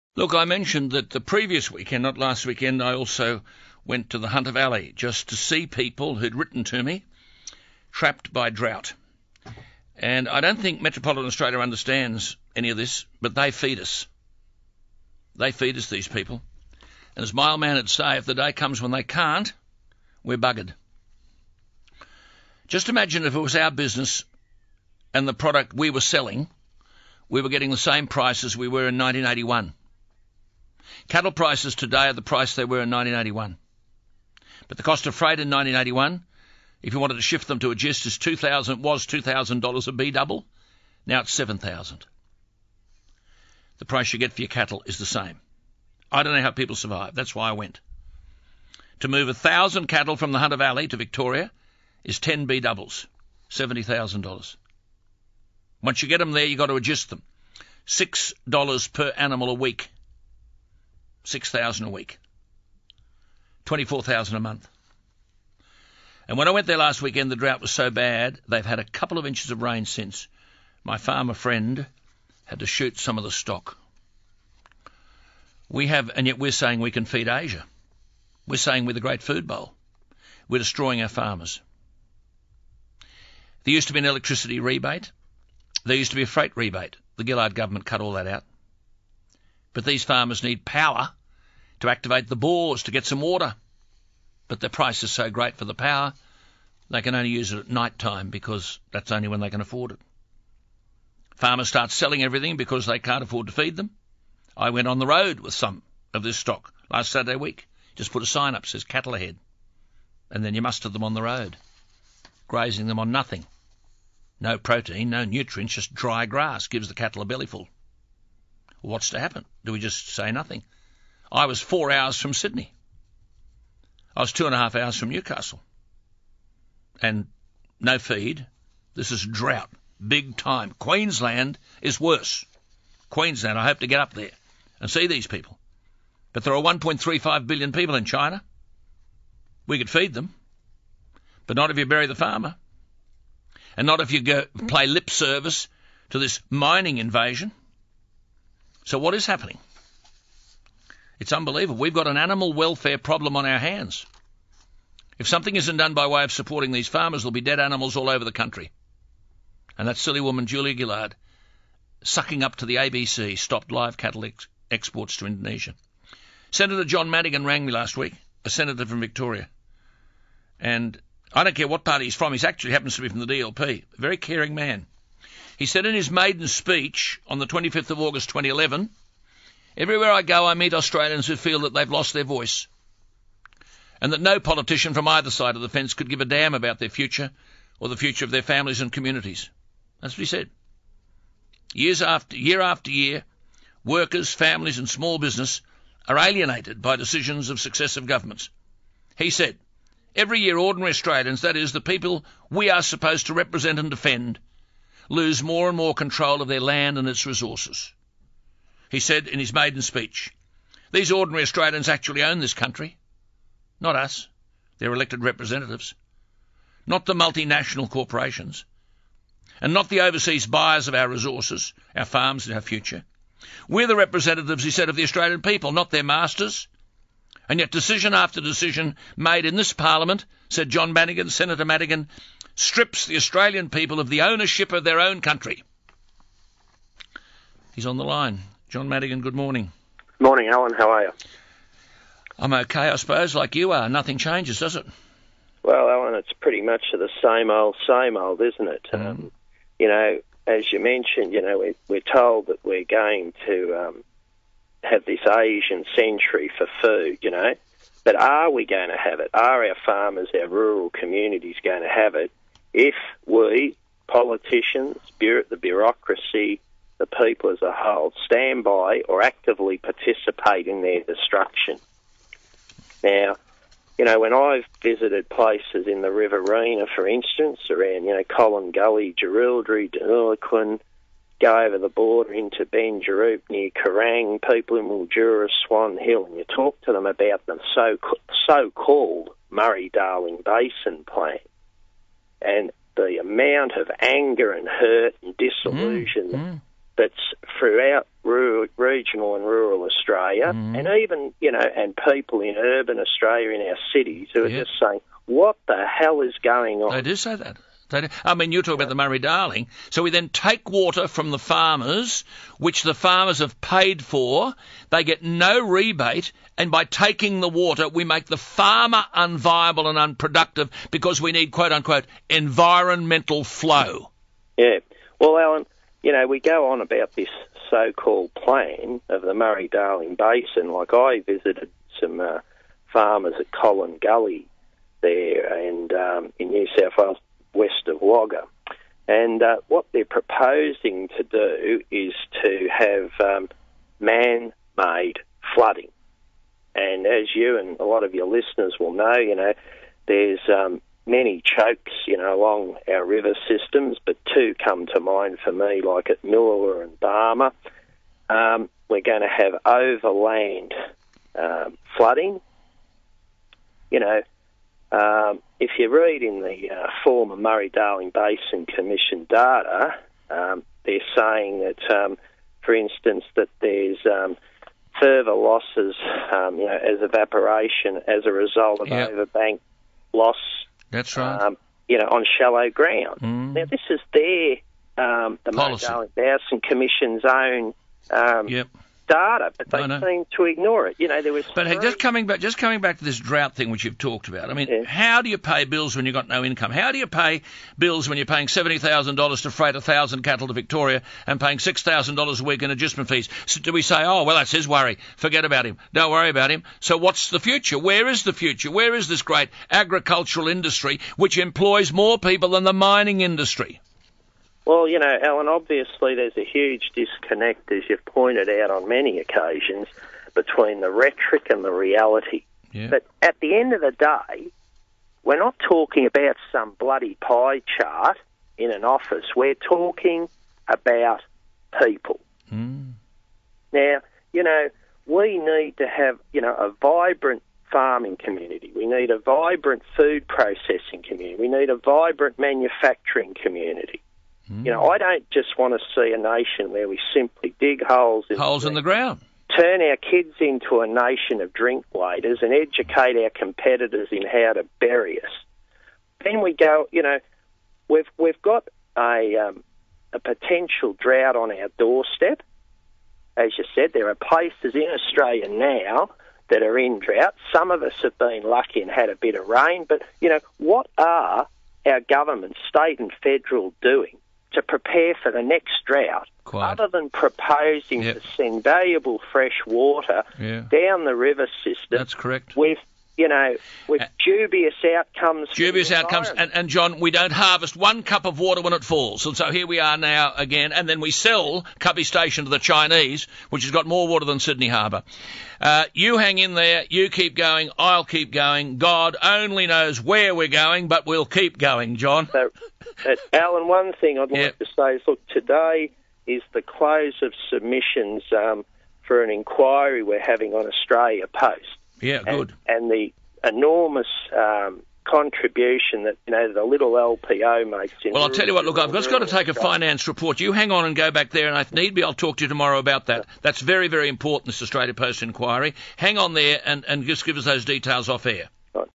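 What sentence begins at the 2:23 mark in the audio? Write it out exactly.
And not if you go play lip service to this mining invasion.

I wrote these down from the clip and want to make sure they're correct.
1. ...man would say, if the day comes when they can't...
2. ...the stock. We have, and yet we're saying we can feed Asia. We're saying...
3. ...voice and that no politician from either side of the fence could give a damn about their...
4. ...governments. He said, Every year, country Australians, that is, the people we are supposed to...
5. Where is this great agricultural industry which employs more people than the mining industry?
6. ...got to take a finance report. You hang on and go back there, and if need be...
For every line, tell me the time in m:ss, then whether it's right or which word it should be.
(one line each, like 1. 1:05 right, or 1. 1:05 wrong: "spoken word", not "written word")
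1. 0:17 right
2. 1:13 right
3. 3:02 right
4. 3:18 wrong: "ordinary", not "country"
5. 6:48 right
6. 8:39 right.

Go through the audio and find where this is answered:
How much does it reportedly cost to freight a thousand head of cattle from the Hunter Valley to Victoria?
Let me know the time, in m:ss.
0:53.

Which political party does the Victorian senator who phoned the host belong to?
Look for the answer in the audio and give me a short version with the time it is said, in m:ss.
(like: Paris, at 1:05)
DLP, at 2:53.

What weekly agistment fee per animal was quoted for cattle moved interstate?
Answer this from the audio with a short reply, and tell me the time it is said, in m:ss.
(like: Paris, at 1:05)
$6, at 0:57.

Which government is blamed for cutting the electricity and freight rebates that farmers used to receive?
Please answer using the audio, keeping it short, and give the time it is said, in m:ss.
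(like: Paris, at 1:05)
The Gillard government, at 1:27.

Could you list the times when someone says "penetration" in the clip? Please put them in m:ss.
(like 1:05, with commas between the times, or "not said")
not said.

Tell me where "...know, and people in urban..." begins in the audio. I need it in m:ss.
5:01.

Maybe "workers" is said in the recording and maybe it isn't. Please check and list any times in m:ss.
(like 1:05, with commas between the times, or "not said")
3:13.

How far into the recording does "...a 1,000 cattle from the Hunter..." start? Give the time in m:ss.
0:49.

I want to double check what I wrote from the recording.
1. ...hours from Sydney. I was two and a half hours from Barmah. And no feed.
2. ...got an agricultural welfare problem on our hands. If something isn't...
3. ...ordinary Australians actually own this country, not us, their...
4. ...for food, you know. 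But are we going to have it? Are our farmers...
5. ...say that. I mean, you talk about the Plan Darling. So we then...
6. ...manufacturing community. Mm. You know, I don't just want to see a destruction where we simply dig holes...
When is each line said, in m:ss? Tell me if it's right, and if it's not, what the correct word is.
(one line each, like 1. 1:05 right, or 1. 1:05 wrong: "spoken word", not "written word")
1. 2:01 wrong: "Newcastle", not "Barmah"
2. 2:31 wrong: "animal", not "agricultural"
3. 3:31 right
4. 4:16 right
5. 5:07 wrong: "Murray", not "Plan"
6. 7:22 wrong: "nation", not "destruction".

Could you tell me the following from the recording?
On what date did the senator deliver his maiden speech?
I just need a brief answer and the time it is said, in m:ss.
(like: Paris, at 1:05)
25 August 2011, at 2:57.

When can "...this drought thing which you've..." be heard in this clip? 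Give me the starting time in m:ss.
6:33.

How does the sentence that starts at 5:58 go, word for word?
Um, we're going to have overland um, flooding.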